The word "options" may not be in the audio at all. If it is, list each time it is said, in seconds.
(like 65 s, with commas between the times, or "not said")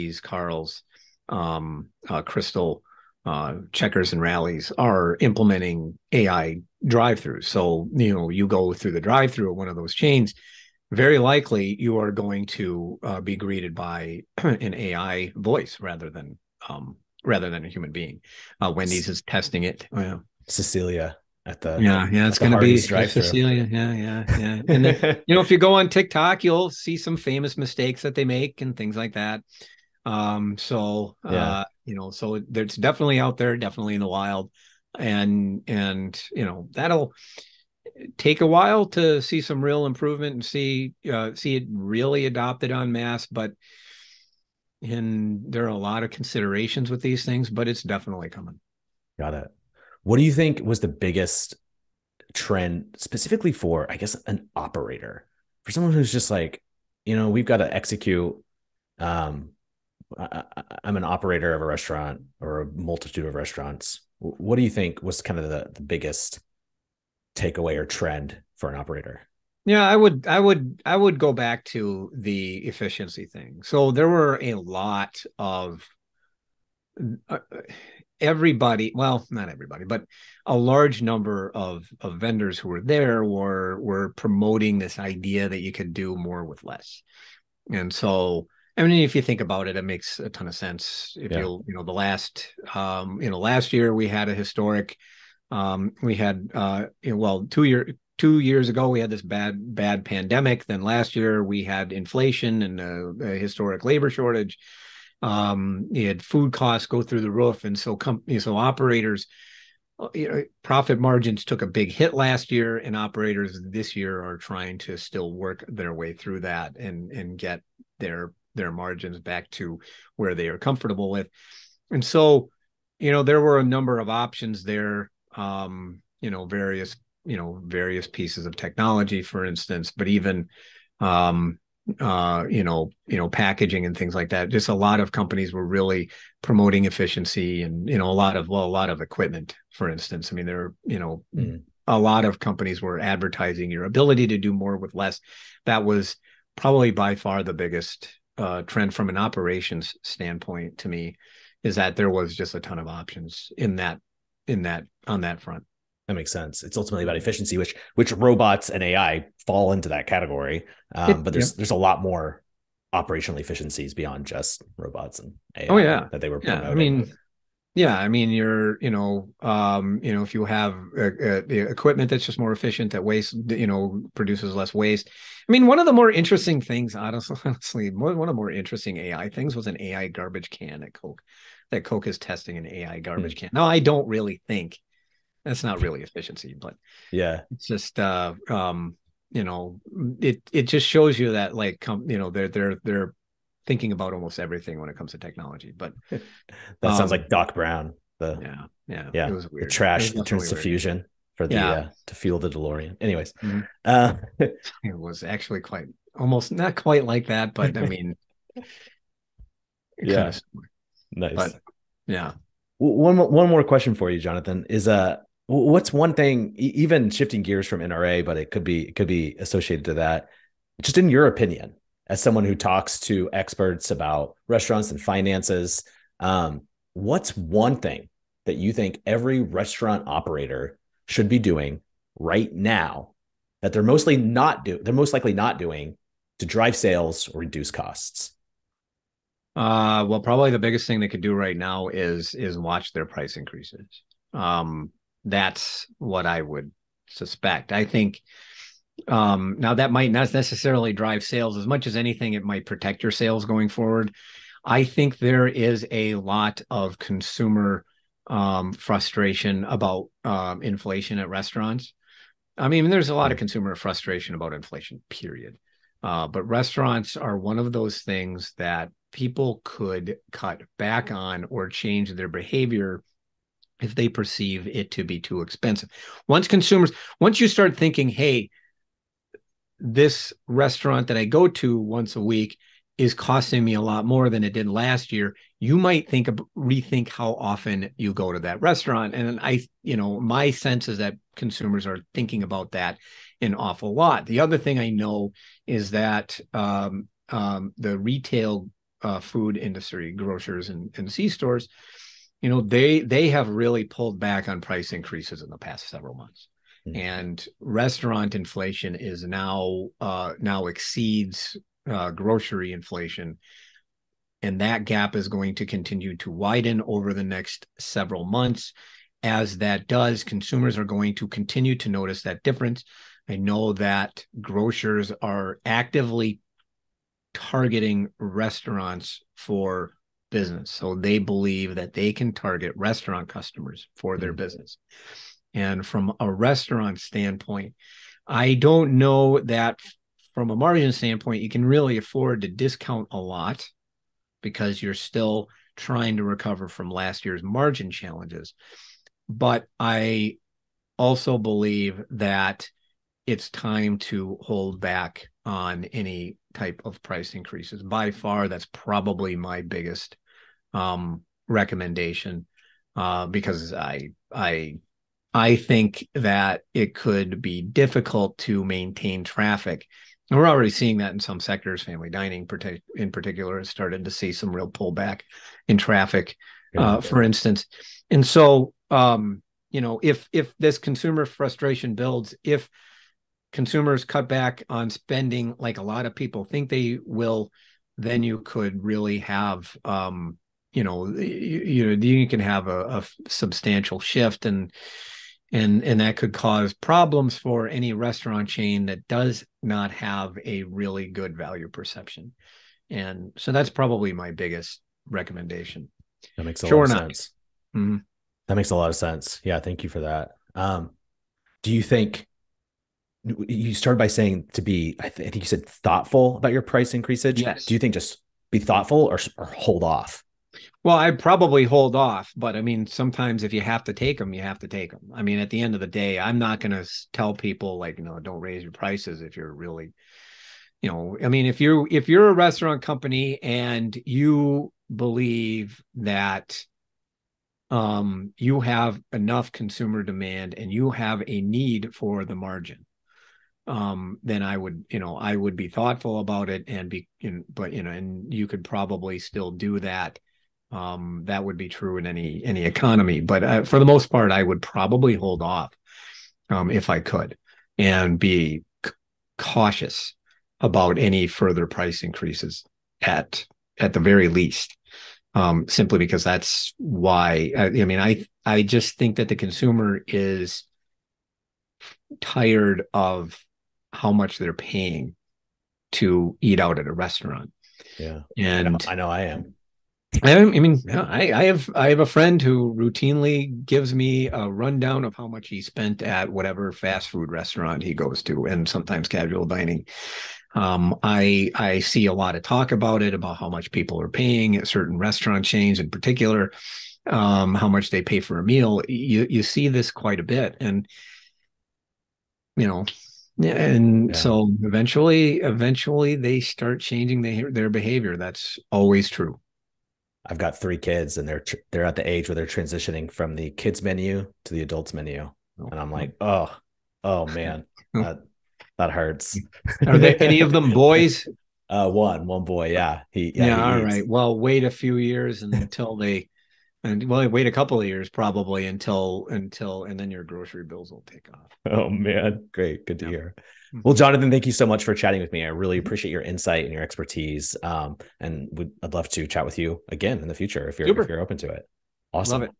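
124 s, 152 s.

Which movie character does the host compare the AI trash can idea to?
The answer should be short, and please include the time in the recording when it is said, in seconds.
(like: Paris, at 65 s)
Doc Brown, at 197 s.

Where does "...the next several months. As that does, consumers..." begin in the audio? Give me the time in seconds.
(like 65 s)
317 s.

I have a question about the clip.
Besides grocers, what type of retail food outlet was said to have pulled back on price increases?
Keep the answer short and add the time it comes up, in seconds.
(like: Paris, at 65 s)
C stores, at 301 s.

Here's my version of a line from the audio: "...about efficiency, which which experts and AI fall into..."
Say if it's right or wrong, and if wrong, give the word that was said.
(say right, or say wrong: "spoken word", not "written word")
wrong: "robots", not "experts".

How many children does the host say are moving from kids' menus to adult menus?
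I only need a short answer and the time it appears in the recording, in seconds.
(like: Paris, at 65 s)
3, at 510 s.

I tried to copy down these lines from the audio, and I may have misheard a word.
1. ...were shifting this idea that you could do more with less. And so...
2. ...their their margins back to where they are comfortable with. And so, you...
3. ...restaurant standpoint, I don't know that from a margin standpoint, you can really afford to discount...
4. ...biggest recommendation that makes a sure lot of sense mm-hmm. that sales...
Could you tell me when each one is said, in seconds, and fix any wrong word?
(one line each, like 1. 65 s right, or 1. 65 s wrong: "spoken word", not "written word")
1. 83 s wrong: "promoting", not "shifting"
2. 118 s right
3. 336 s right
4. 404 s wrong: "makes", not "sales".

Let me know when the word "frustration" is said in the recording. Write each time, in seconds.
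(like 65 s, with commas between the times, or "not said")
258 s, 263 s, 381 s.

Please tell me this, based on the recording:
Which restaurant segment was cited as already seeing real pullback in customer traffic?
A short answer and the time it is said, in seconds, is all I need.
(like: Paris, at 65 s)
Family dining, at 371 s.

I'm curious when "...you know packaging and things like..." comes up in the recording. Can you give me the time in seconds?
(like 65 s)
133 s.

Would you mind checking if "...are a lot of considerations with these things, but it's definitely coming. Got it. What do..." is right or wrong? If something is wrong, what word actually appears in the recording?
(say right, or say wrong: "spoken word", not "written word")
right.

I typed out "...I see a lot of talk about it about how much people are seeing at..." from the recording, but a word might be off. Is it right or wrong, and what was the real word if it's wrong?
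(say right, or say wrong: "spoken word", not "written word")
wrong: "paying", not "seeing".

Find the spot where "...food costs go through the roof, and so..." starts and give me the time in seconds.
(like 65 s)
106 s.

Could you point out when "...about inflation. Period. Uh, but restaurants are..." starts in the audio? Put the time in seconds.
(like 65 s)
264 s.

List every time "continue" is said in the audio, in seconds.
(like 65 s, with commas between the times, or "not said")
315 s, 321 s.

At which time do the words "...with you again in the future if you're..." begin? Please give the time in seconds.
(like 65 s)
539 s.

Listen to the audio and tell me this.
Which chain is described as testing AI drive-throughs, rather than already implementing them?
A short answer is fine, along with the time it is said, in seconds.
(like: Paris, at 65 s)
Wendy's, at 18 s.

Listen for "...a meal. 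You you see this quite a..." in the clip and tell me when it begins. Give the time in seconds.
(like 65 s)
498 s.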